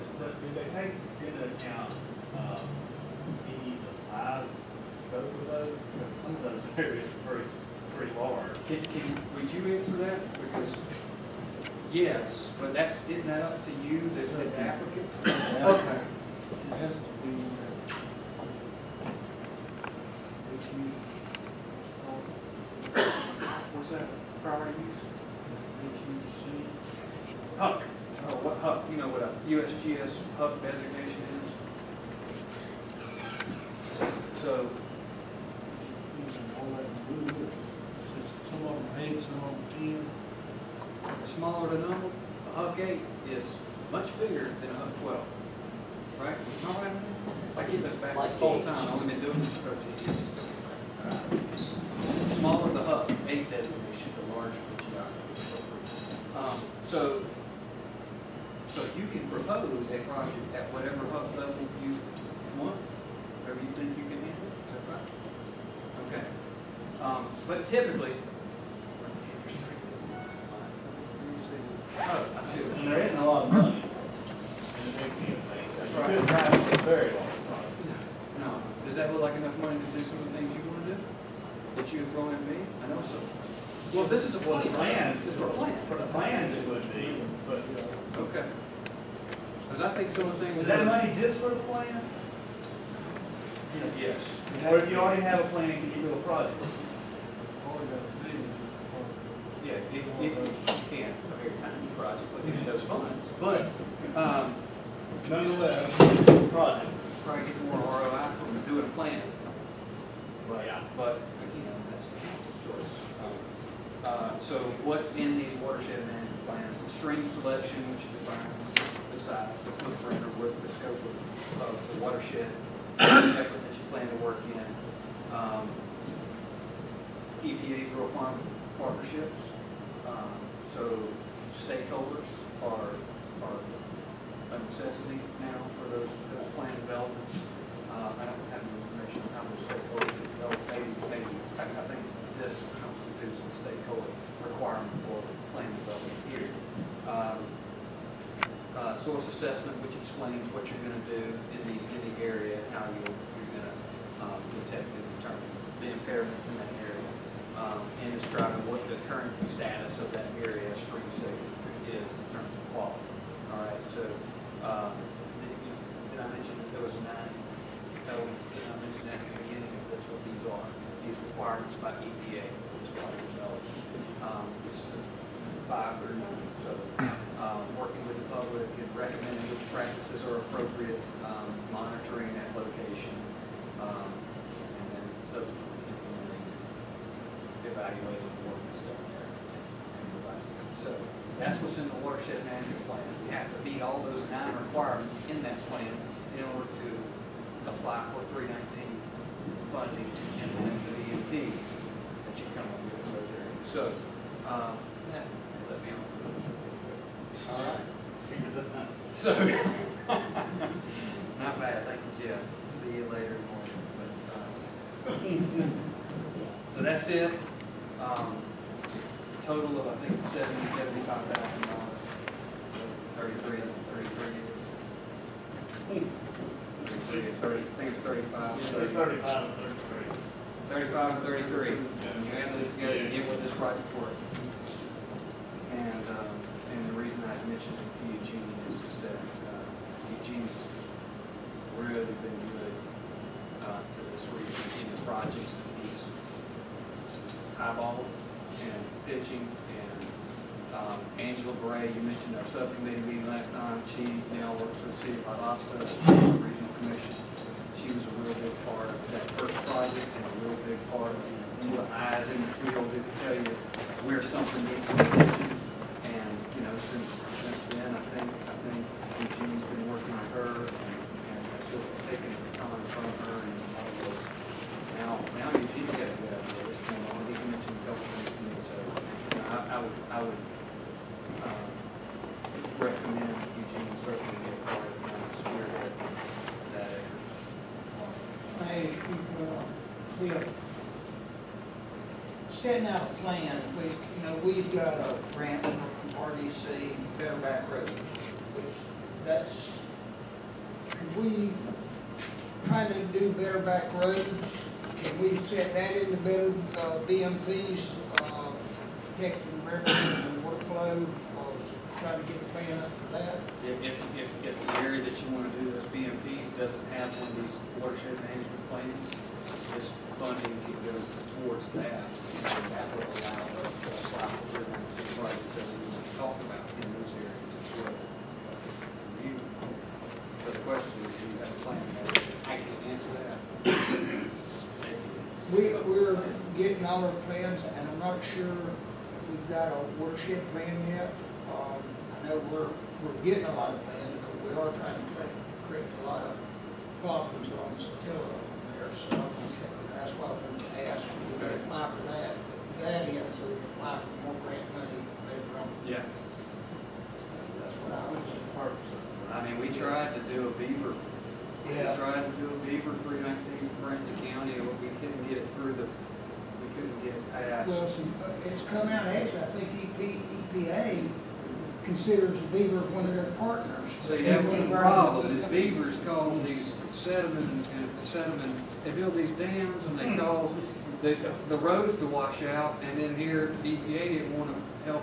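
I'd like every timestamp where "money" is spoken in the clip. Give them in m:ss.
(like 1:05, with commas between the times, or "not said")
1:30, 5:54.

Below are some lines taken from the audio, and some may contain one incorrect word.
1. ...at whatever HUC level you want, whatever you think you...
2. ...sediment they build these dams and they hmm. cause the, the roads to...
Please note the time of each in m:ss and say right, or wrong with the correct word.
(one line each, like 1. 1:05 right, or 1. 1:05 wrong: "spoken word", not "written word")
1. 1:00 right
2. 6:18 right.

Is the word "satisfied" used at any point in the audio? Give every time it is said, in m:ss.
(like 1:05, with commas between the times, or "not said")
not said.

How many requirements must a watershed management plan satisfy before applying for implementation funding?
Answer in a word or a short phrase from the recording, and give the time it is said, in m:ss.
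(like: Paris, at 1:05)
9, at 3:14.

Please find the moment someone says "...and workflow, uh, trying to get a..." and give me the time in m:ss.
5:09.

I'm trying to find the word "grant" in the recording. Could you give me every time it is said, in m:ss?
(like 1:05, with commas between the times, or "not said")
4:55, 5:54.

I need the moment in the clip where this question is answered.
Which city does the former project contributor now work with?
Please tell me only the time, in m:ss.
4:15.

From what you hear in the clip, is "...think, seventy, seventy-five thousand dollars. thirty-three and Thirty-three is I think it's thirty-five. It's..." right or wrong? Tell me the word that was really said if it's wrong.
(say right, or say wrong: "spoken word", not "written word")
right.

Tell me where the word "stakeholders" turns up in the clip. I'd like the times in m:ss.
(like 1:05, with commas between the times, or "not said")
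2:11, 2:19, 2:23.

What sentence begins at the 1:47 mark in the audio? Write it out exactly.
Try to get more ROI from doing a plan.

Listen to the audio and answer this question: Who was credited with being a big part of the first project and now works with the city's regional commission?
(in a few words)
Angela Bray.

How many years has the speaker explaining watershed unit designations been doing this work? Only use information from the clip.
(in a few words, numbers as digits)
13 years.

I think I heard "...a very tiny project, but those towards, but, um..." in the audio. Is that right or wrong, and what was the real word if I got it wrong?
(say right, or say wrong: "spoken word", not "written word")
wrong: "funds", not "towards".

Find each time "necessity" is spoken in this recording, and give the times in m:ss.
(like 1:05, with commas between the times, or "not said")
2:14.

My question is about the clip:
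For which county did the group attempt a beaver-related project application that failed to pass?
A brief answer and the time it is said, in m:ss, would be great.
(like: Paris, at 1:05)
Brandon County, at 6:03.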